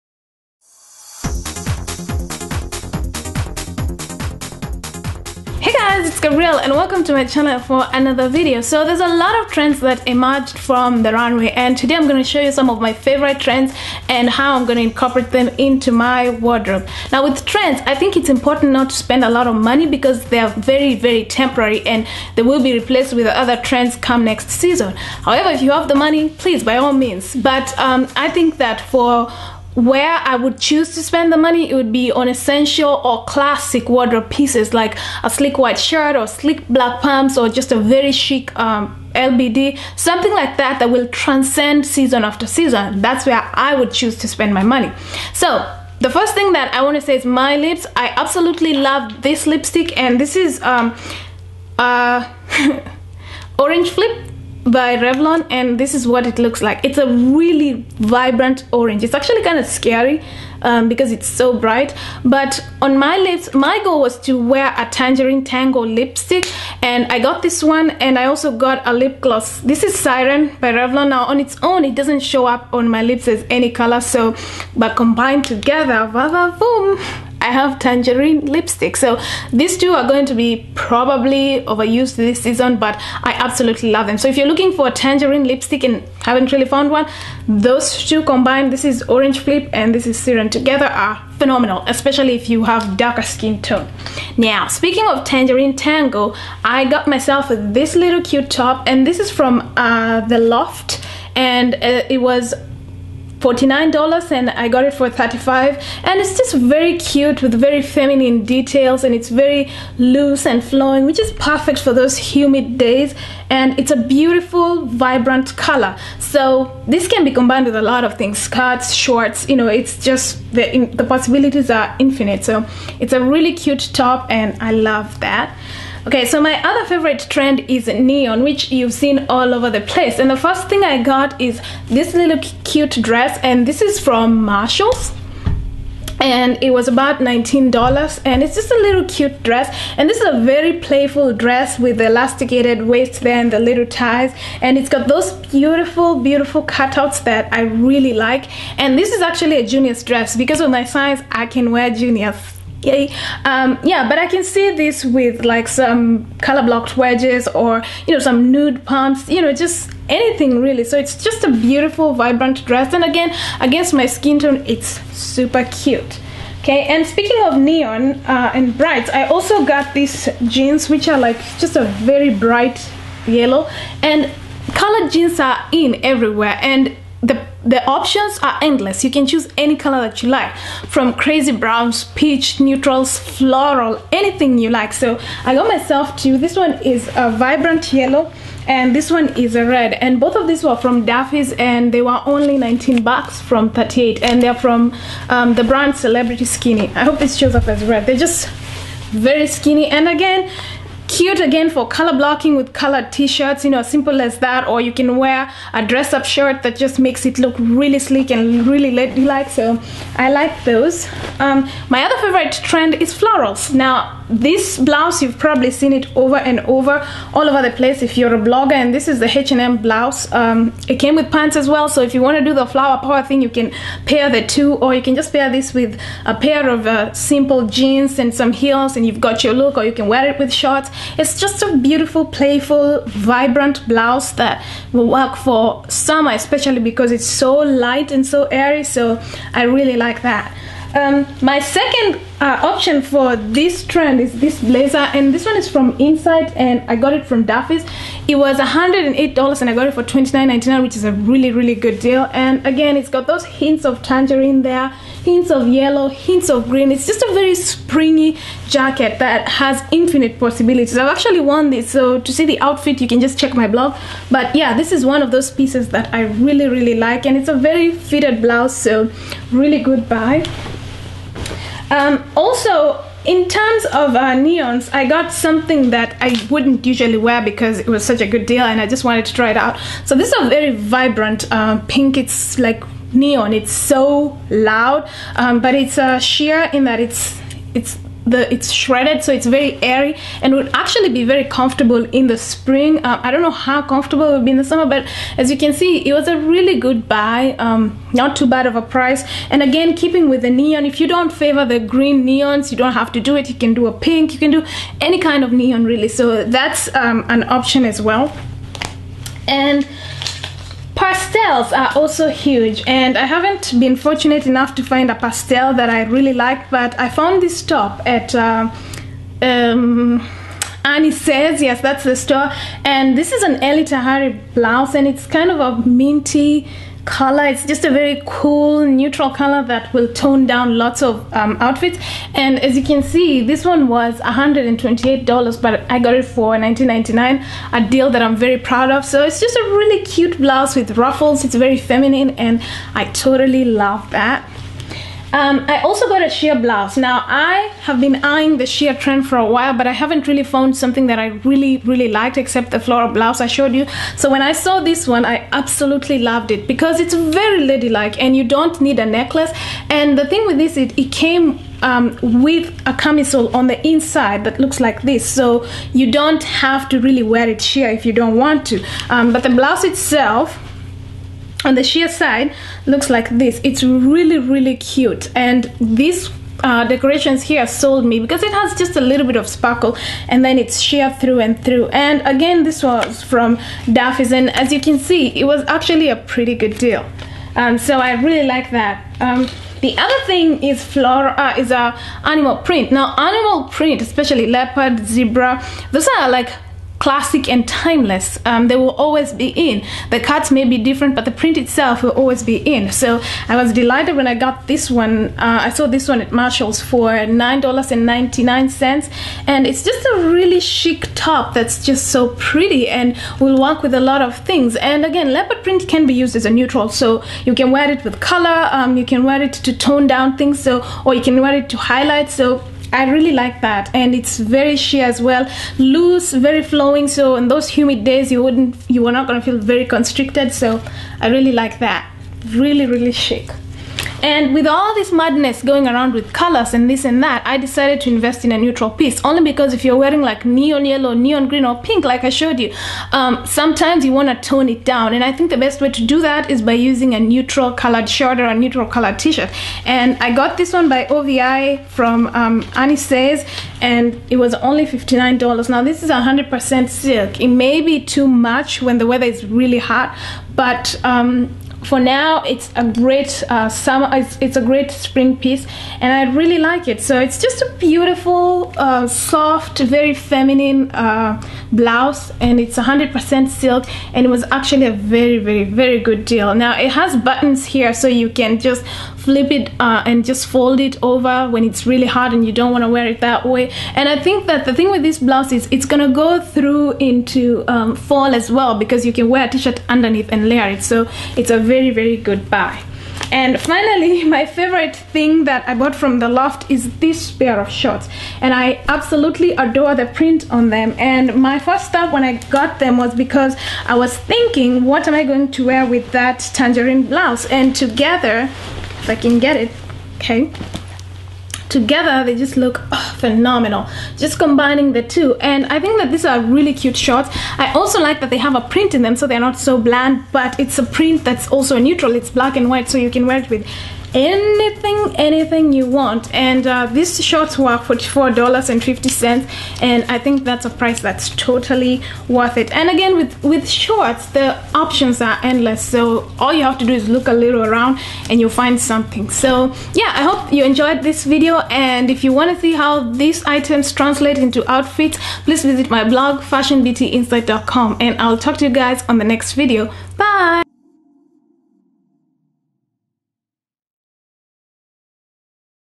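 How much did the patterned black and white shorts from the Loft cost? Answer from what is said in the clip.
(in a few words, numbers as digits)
$44.50.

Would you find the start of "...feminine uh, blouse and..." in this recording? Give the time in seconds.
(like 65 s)
470 s.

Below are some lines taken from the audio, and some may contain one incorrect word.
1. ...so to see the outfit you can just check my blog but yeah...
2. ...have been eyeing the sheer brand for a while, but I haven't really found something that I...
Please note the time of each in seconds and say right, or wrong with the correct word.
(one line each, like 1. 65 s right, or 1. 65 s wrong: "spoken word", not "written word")
1. 261 s right
2. 347 s wrong: "trend", not "brand".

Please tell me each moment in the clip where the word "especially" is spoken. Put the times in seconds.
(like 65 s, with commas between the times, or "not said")
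91 s, 236 s, 393 s.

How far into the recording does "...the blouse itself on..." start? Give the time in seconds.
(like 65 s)
369 s.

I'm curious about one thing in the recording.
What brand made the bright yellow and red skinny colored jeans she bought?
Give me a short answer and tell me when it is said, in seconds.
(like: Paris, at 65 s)
Celebrity Skinny, at 195 s.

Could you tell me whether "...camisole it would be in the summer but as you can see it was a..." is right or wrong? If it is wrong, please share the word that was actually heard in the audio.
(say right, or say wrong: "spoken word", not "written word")
wrong: "comfortable", not "camisole".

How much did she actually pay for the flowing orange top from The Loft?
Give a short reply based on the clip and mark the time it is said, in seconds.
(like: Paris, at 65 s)
$35, at 105 s.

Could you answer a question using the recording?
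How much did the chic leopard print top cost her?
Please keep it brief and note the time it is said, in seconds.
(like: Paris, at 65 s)
$9.99, at 407 s.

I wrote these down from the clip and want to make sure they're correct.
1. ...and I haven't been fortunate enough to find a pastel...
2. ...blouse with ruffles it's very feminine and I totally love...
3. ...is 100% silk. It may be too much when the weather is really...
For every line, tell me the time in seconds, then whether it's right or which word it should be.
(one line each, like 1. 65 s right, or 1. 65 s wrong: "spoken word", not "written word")
1. 312 s right
2. 340 s right
3. 456 s right.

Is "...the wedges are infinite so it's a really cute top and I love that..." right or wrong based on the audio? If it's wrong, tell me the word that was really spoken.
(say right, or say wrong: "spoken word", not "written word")
wrong: "possibilities", not "wedges".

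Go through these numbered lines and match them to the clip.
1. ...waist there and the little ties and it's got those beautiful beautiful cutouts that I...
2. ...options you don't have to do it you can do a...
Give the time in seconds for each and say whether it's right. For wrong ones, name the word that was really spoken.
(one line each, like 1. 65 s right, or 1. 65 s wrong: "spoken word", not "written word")
1. 142 s right
2. 302 s wrong: "neons", not "options".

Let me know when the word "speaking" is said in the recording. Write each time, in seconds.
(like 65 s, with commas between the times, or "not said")
94 s, 167 s.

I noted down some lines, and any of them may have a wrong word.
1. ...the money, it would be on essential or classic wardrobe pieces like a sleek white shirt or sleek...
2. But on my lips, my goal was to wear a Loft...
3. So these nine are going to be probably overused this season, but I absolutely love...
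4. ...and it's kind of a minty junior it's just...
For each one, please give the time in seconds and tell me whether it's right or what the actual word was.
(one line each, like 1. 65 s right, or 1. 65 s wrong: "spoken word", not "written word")
1. 31 s right
2. 62 s wrong: "Tangerine", not "Loft"
3. 78 s wrong: "two", not "nine"
4. 324 s wrong: "color", not "junior".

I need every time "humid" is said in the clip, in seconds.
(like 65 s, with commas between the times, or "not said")
112 s, 427 s.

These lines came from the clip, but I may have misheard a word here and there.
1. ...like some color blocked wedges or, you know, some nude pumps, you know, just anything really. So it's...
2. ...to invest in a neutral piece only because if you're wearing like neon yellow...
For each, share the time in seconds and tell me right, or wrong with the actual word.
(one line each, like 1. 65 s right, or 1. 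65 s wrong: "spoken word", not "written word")
1. 155 s right
2. 438 s right.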